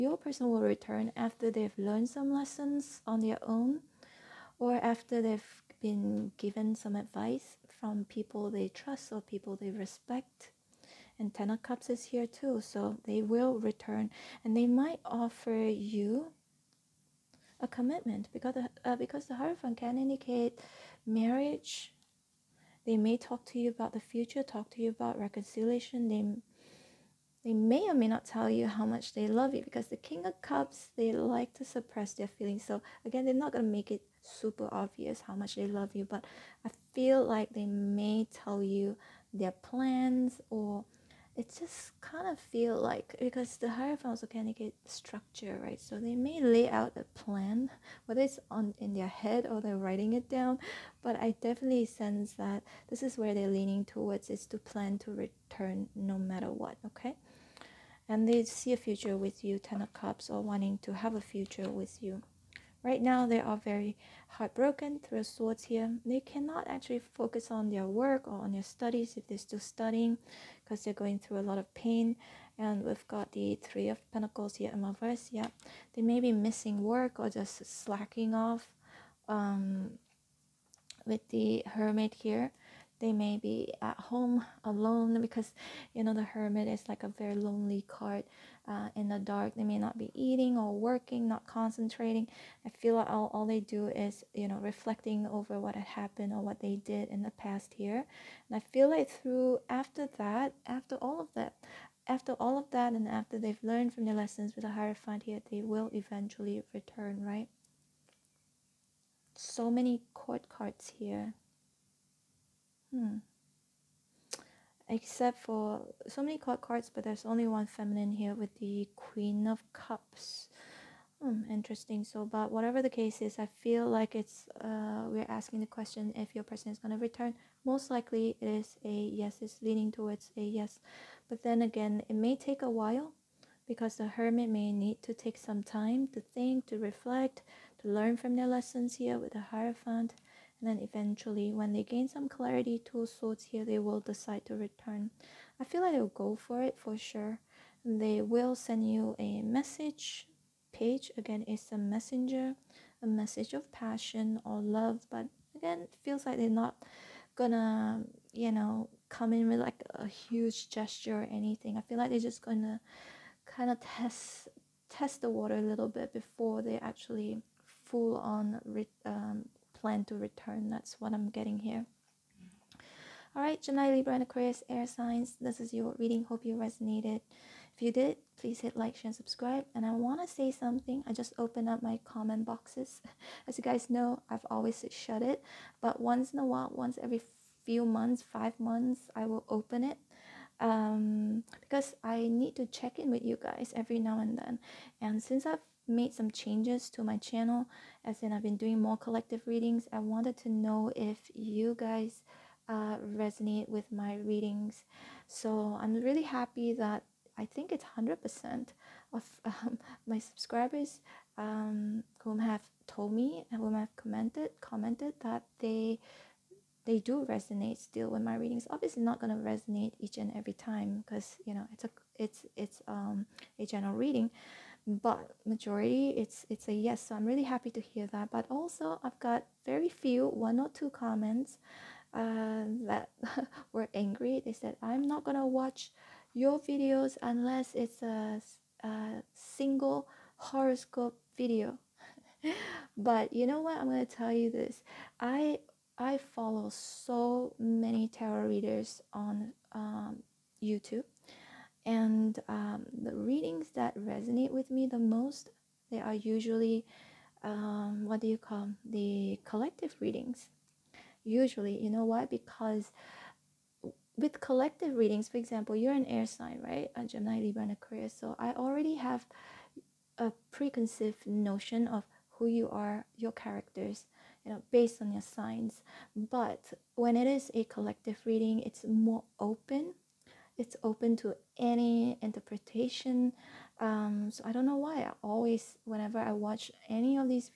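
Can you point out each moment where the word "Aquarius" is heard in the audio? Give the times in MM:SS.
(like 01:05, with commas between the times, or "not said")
02:54, 04:27.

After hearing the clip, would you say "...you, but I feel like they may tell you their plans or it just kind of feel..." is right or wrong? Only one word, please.
right.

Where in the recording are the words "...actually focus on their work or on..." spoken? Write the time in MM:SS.
01:06.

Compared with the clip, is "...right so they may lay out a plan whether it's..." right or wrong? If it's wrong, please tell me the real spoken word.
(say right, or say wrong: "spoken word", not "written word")
right.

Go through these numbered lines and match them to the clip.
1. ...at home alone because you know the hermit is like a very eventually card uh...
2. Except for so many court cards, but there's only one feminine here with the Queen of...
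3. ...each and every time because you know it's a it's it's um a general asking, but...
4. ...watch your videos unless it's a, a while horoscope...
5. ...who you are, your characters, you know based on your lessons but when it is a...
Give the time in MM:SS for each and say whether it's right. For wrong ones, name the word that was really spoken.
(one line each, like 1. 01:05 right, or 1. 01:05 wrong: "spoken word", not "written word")
1. 01:23 wrong: "lonely", not "eventually"
2. 01:54 right
3. 03:39 wrong: "reading", not "asking"
4. 03:55 wrong: "single", not "while"
5. 04:32 wrong: "signs", not "lessons".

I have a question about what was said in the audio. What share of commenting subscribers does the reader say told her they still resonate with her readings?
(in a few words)
100%.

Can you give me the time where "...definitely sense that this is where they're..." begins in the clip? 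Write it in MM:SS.
00:51.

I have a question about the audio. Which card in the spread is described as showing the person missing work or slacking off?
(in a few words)
Three of Pentacles.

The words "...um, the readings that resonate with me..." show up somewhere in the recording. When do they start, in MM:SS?
04:12.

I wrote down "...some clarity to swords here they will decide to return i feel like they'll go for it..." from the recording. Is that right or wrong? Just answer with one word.
right.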